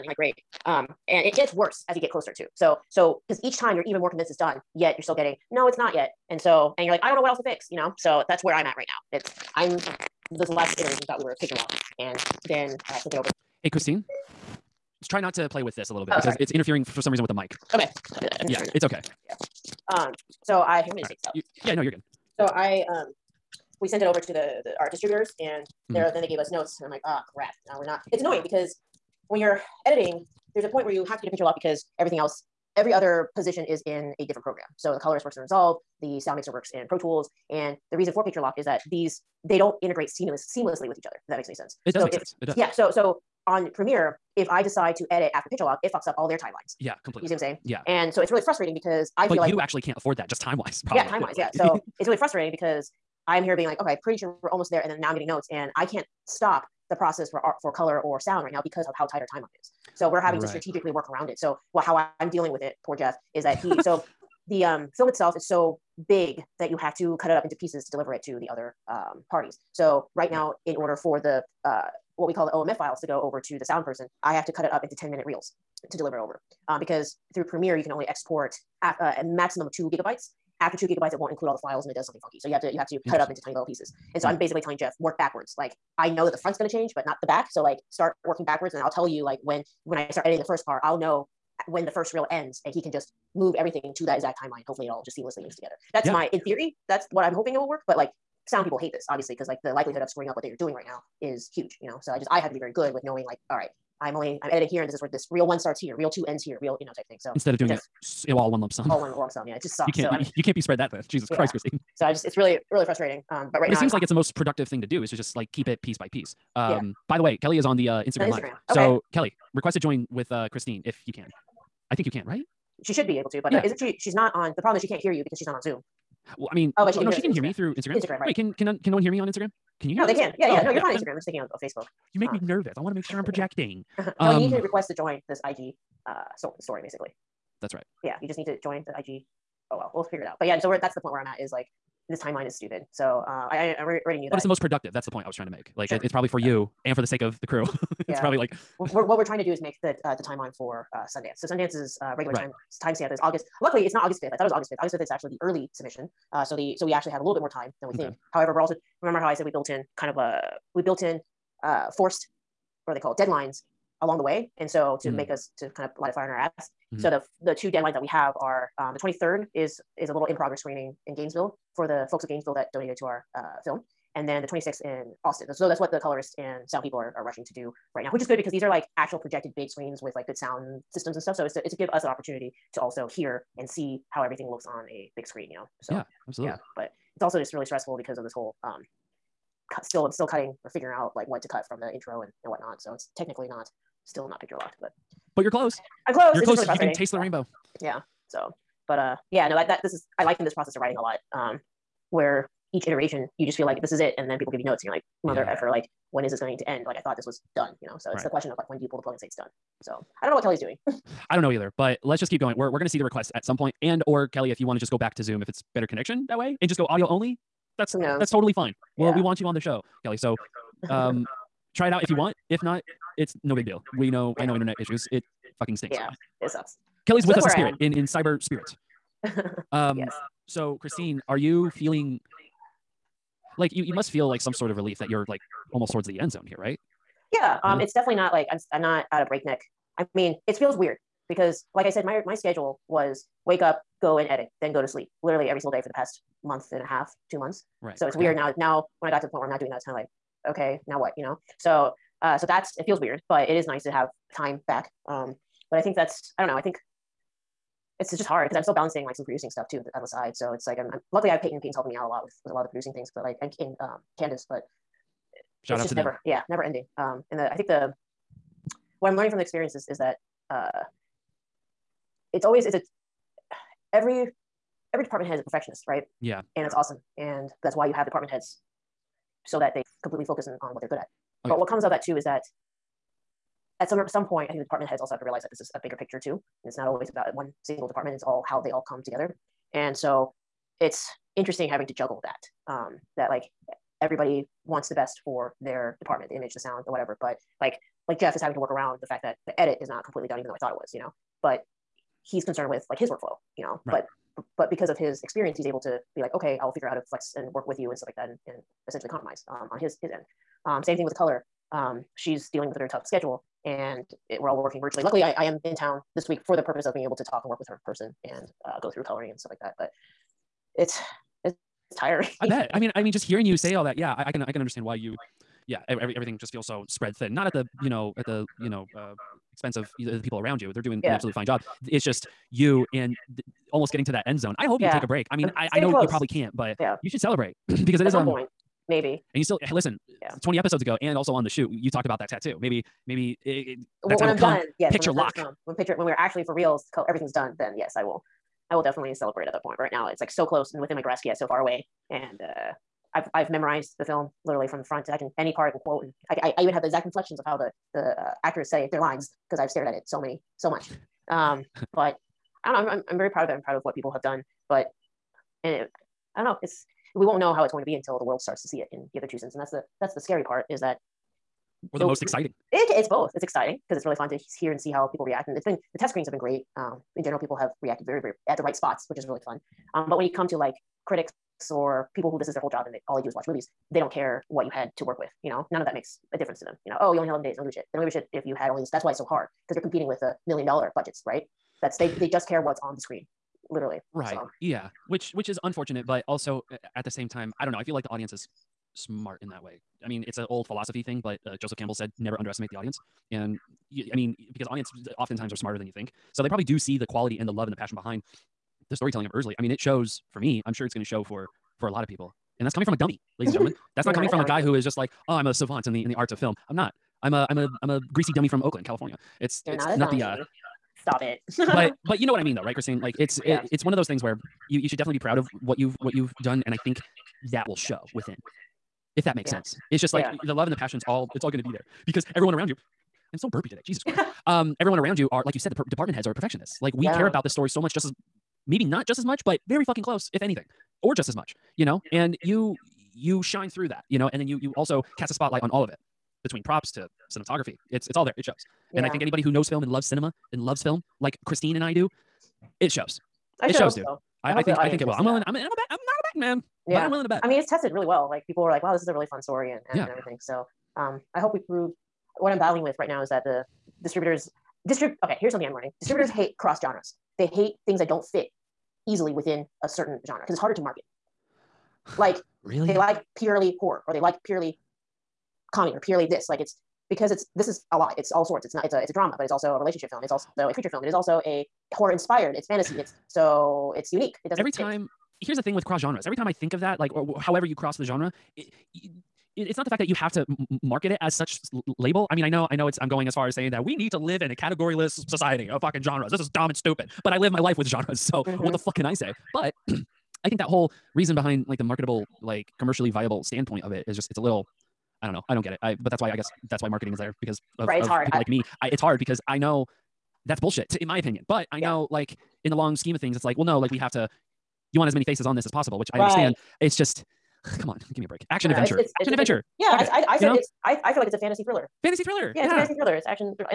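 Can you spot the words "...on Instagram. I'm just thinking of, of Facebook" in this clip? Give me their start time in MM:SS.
02:10.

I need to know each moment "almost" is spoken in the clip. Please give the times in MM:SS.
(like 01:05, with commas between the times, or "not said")
00:54, 03:55, 05:33.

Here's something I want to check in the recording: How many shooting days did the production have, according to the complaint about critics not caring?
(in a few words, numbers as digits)
11.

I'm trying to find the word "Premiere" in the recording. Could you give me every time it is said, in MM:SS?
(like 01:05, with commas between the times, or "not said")
00:43, 01:17.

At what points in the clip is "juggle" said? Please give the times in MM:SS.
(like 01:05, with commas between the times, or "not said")
04:51.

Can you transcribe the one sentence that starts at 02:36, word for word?
Uh, so the so we actually have a little bit more time than we okay.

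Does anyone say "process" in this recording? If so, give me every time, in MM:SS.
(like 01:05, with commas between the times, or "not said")
00:56, 03:20.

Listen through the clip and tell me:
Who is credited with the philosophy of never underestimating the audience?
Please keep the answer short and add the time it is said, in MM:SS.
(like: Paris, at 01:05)
Joseph Campbell, at 06:41.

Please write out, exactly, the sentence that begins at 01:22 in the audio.
So you have to you have to cut it up into tiny little pieces.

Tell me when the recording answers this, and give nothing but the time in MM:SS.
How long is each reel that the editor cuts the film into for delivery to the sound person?
01:14.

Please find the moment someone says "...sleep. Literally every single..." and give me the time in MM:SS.
04:04.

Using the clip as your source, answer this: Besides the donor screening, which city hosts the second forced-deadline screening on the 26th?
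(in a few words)
Austin.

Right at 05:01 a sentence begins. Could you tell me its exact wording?
But he's concerned with like his workflow, you know.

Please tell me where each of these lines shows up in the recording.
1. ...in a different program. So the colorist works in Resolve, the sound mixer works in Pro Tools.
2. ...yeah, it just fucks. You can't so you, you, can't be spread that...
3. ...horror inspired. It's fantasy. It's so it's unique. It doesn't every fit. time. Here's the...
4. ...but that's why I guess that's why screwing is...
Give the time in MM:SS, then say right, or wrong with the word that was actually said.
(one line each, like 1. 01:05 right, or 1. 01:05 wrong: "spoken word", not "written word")
1. 00:33 right
2. 01:49 wrong: "sucks", not "fucks"
3. 08:01 right
4. 08:25 wrong: "marketing", not "screwing".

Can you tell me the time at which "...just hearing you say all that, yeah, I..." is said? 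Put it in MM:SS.
05:23.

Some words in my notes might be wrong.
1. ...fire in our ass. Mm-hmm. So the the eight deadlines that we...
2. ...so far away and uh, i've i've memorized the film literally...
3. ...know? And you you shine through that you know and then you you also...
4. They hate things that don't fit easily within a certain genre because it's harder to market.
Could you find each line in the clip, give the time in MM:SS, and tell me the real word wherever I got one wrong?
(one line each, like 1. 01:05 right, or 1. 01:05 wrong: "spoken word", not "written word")
1. 02:46 wrong: "two", not "eight"
2. 05:51 right
3. 07:21 right
4. 07:47 right.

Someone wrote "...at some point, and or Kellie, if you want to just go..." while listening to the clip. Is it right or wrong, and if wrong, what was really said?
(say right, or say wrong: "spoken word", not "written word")
right.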